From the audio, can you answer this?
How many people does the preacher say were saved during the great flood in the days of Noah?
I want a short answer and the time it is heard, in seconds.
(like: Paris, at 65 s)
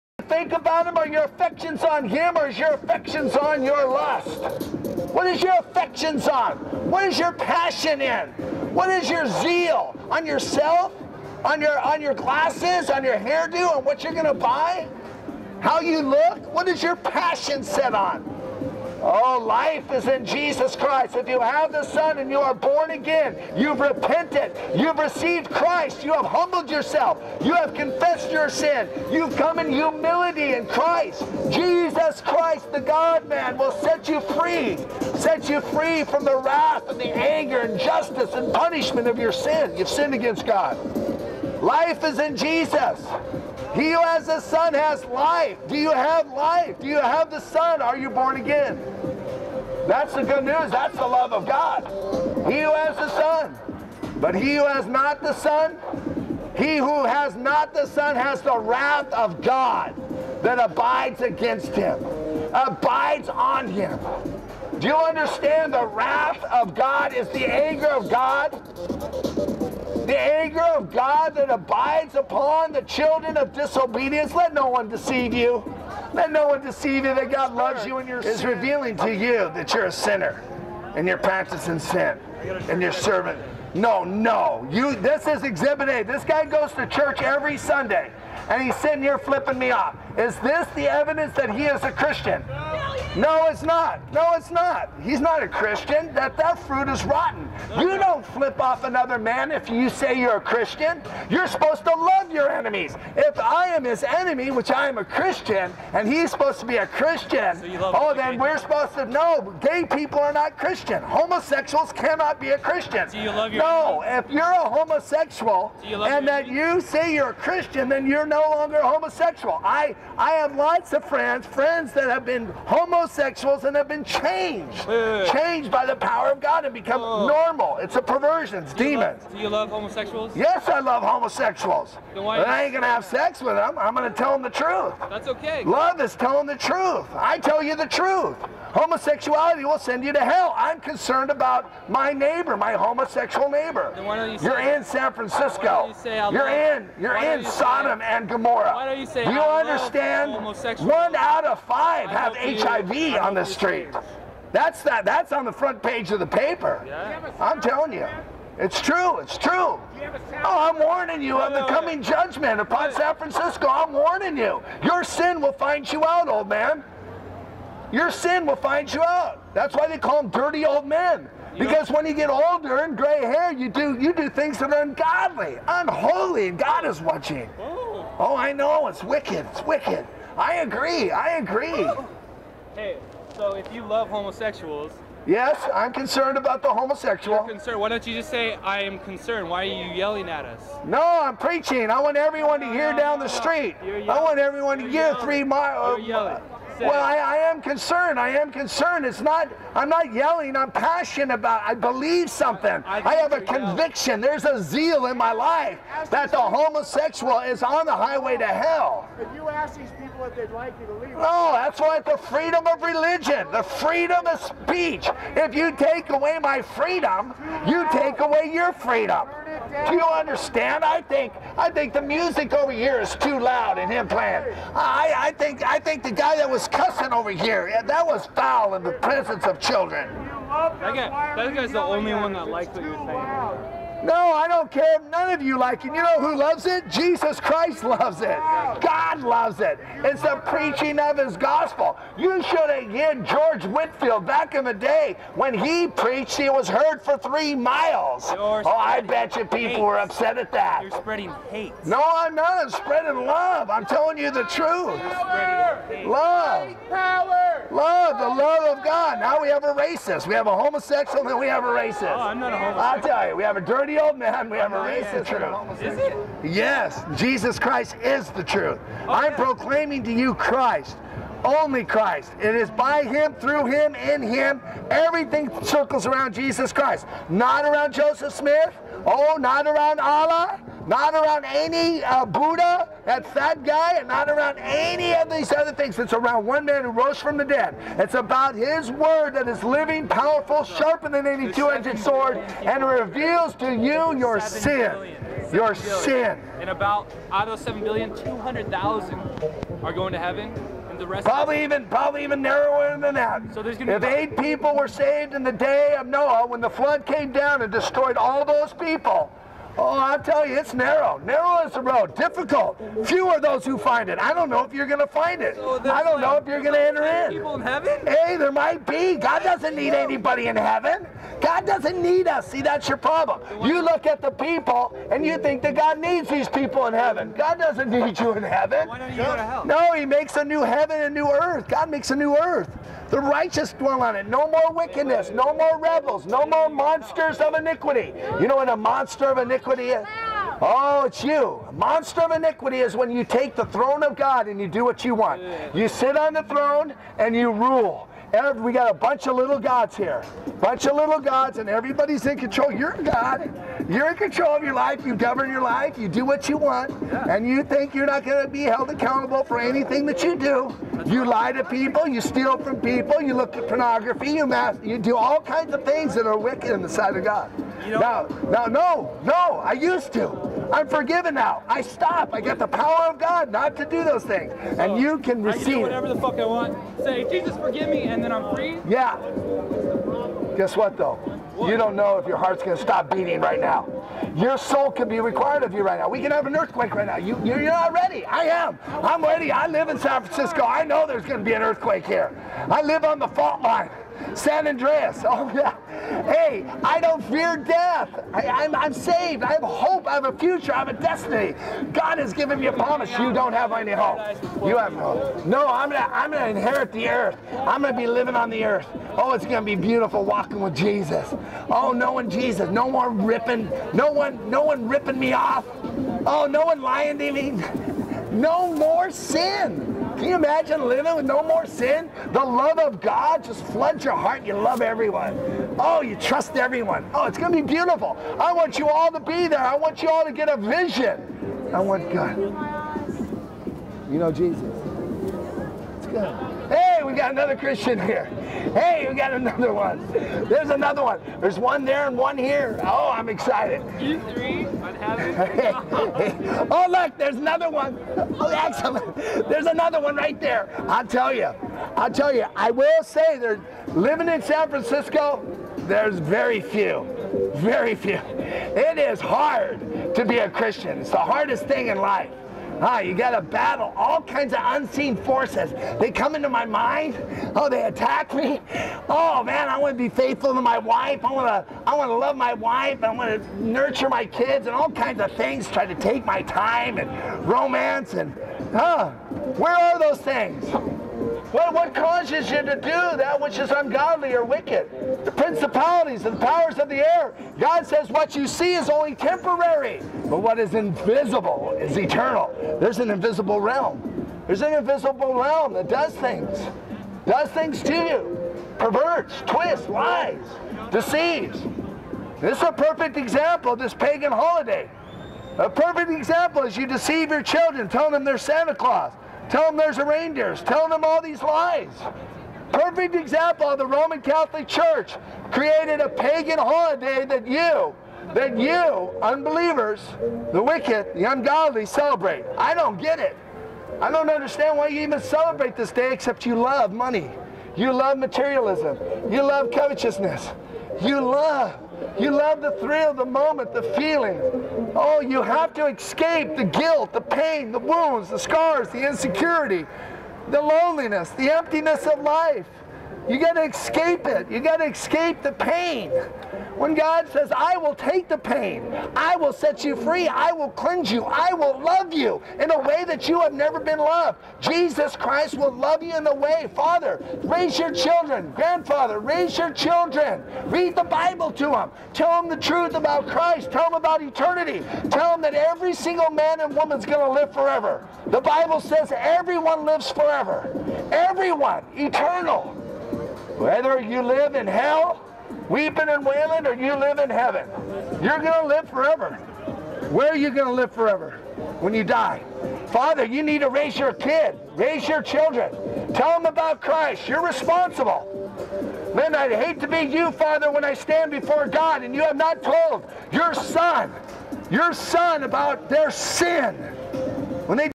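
8, at 304 s.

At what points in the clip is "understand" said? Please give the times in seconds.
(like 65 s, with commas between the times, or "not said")
64 s, 149 s, 220 s, 524 s.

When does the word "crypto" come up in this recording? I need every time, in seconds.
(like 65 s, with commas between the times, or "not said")
not said.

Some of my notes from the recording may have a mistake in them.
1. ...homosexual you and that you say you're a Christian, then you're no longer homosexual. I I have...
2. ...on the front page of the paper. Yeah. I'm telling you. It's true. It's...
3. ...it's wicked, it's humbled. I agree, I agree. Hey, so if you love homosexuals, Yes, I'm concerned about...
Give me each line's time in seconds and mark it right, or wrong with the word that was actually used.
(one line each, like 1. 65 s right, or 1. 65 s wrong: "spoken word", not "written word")
1. 114 s right
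2. 155 s right
3. 178 s wrong: "wicked", not "humbled".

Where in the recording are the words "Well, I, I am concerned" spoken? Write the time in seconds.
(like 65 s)
196 s.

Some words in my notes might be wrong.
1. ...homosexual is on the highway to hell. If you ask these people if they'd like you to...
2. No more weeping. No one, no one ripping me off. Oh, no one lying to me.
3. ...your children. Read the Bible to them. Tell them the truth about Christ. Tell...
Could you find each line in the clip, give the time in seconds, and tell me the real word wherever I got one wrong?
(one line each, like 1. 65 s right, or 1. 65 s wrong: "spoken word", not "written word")
1. 206 s right
2. 412 s wrong: "ripping", not "weeping"
3. 559 s right.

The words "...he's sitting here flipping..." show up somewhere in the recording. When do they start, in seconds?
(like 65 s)
88 s.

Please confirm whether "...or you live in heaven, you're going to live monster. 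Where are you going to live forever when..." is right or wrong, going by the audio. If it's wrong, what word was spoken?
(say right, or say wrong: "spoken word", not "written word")
wrong: "forever", not "monster".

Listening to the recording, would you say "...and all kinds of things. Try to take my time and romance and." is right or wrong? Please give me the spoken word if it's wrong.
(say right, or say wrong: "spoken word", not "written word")
right.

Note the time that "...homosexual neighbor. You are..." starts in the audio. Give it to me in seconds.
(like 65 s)
142 s.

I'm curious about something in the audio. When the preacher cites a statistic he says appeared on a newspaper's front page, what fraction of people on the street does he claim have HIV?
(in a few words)
1 in 5.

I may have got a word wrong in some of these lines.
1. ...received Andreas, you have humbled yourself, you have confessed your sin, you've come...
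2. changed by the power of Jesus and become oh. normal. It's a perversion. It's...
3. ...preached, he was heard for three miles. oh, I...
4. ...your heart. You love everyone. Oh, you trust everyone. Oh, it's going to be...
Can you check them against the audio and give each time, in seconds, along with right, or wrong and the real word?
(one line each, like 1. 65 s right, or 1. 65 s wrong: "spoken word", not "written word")
1. 24 s wrong: "Christ", not "Andreas"
2. 125 s wrong: "God", not "Jesus"
3. 245 s right
4. 424 s right.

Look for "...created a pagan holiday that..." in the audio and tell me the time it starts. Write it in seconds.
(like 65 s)
515 s.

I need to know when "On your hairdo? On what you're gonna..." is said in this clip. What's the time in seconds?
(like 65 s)
12 s.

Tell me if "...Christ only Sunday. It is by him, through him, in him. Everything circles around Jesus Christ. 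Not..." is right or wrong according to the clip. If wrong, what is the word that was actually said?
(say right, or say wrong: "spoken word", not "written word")
wrong: "Christ", not "Sunday".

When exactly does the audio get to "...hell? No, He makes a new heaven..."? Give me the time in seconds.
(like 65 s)
329 s.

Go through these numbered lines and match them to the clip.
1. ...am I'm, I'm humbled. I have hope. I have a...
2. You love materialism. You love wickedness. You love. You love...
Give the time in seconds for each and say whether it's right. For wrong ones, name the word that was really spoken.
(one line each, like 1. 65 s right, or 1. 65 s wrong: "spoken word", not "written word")
1. 398 s wrong: "saved", not "humbled"
2. 527 s wrong: "covetousness", not "wickedness".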